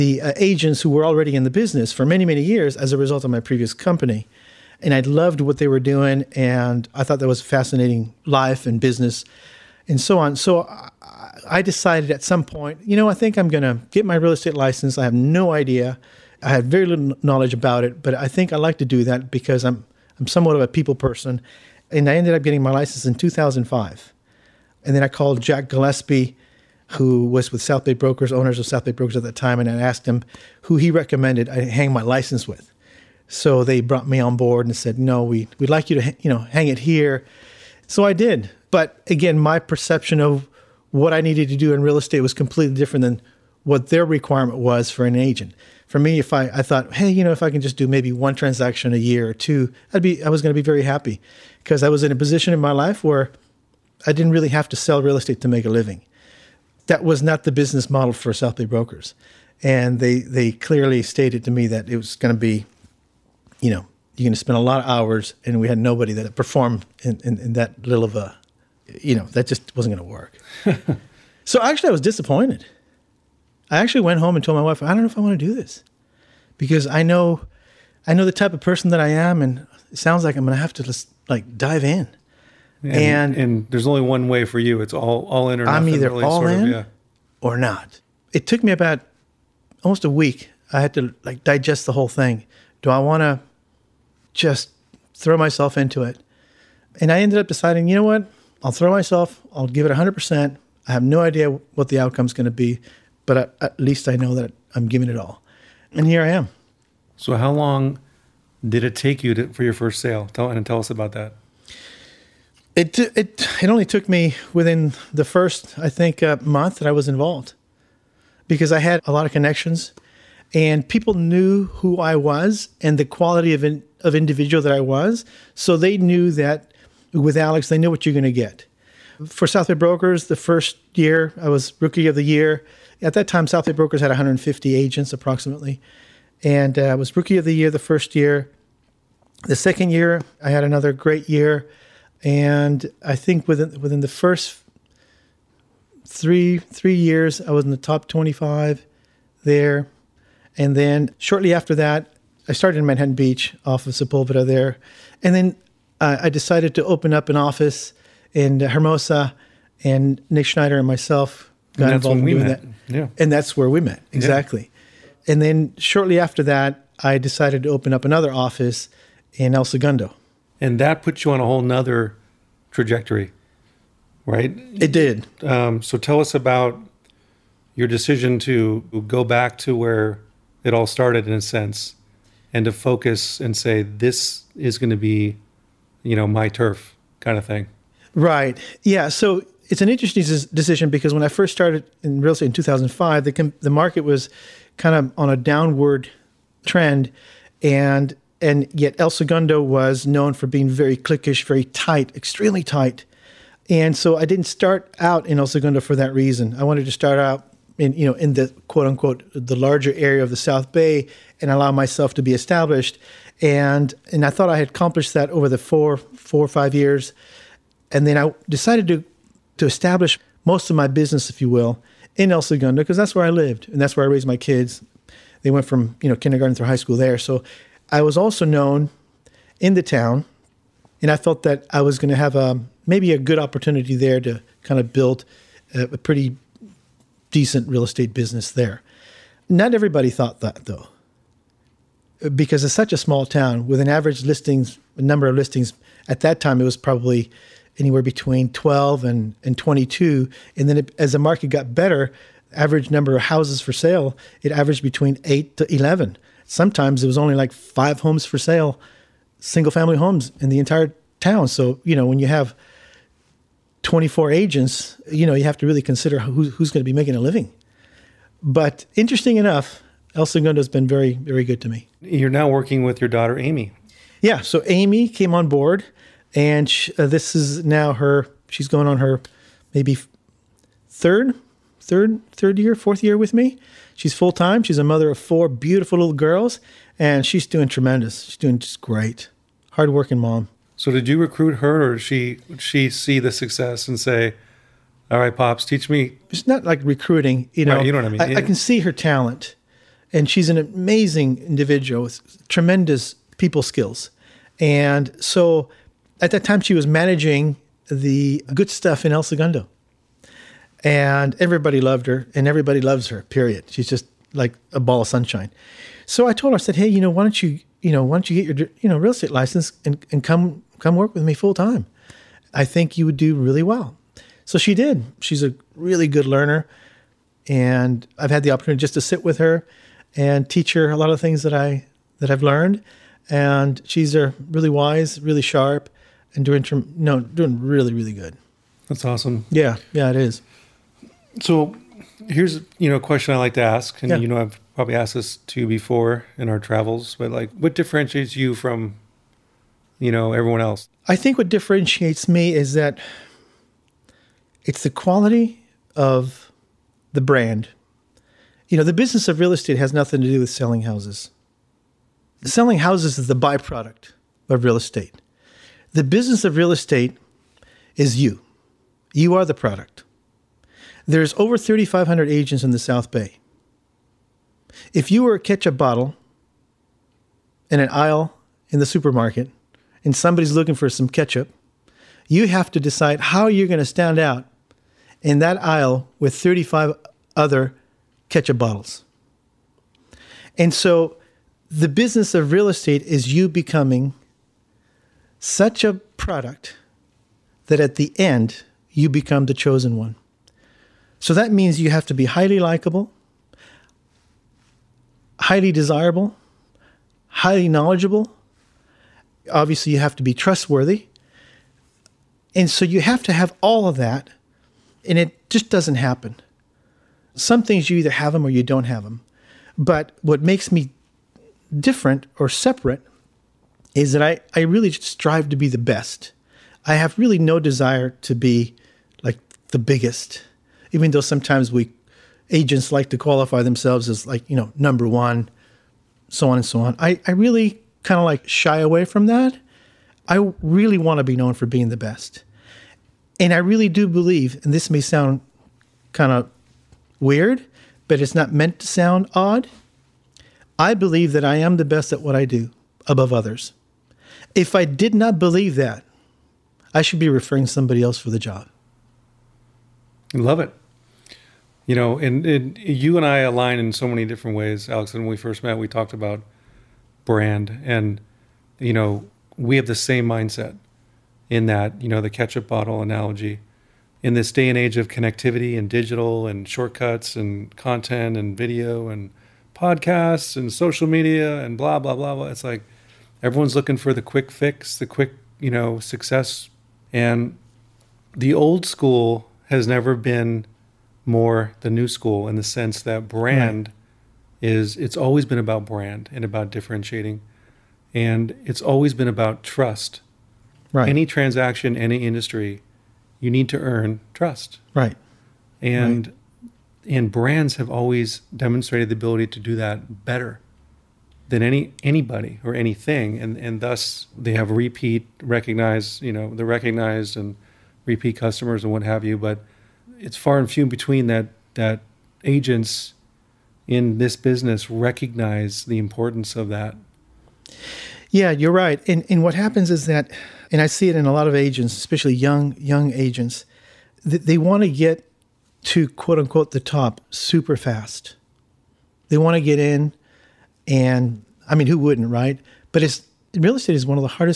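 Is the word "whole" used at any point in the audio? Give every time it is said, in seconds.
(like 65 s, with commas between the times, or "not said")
91 s, 171 s.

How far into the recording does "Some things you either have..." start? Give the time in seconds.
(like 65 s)
417 s.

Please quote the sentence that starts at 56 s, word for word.
That was not the business model for South Bay brokers.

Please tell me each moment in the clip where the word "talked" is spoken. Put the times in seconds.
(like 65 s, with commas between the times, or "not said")
465 s.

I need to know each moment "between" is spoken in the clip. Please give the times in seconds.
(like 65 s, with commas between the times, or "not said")
248 s, 254 s, 520 s.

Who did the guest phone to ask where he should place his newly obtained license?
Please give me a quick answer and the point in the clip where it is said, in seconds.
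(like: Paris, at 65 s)
Jack Gillespie, at 25 s.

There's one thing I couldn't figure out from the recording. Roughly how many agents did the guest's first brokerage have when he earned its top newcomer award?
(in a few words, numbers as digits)
150.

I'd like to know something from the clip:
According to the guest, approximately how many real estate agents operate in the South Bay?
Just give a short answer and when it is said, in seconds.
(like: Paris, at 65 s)
3,500, at 371 s.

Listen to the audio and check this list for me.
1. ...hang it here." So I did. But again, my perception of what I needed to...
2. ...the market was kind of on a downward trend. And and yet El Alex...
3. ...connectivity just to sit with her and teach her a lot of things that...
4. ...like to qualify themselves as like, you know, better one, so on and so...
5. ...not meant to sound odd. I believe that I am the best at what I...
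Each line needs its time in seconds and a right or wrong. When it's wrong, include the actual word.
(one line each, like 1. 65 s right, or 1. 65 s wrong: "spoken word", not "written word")
1. 36 s right
2. 193 s wrong: "Segundo", not "Alex"
3. 328 s wrong: "opportunity", not "connectivity"
4. 432 s wrong: "number", not "better"
5. 448 s right.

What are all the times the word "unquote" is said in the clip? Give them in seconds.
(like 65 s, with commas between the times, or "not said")
208 s, 536 s.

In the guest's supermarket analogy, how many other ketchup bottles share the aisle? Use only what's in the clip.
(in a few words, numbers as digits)
35.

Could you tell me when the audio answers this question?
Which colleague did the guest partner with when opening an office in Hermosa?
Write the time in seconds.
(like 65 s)
160 s.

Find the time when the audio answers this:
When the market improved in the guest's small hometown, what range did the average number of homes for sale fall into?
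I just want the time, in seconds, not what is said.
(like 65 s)
255 s.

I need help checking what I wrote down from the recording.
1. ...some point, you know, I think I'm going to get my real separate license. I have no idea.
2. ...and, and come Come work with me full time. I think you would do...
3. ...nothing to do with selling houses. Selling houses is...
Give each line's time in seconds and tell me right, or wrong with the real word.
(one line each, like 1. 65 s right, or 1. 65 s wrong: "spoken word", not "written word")
1. 12 s wrong: "estate", not "separate"
2. 319 s right
3. 359 s right.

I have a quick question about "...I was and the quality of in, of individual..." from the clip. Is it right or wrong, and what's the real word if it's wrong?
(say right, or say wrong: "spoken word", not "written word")
right.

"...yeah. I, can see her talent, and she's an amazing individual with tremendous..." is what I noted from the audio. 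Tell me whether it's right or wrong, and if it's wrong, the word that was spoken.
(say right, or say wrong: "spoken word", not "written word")
right.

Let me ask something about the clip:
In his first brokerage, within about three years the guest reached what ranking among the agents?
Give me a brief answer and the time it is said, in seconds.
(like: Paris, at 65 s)
top 25, at 147 s.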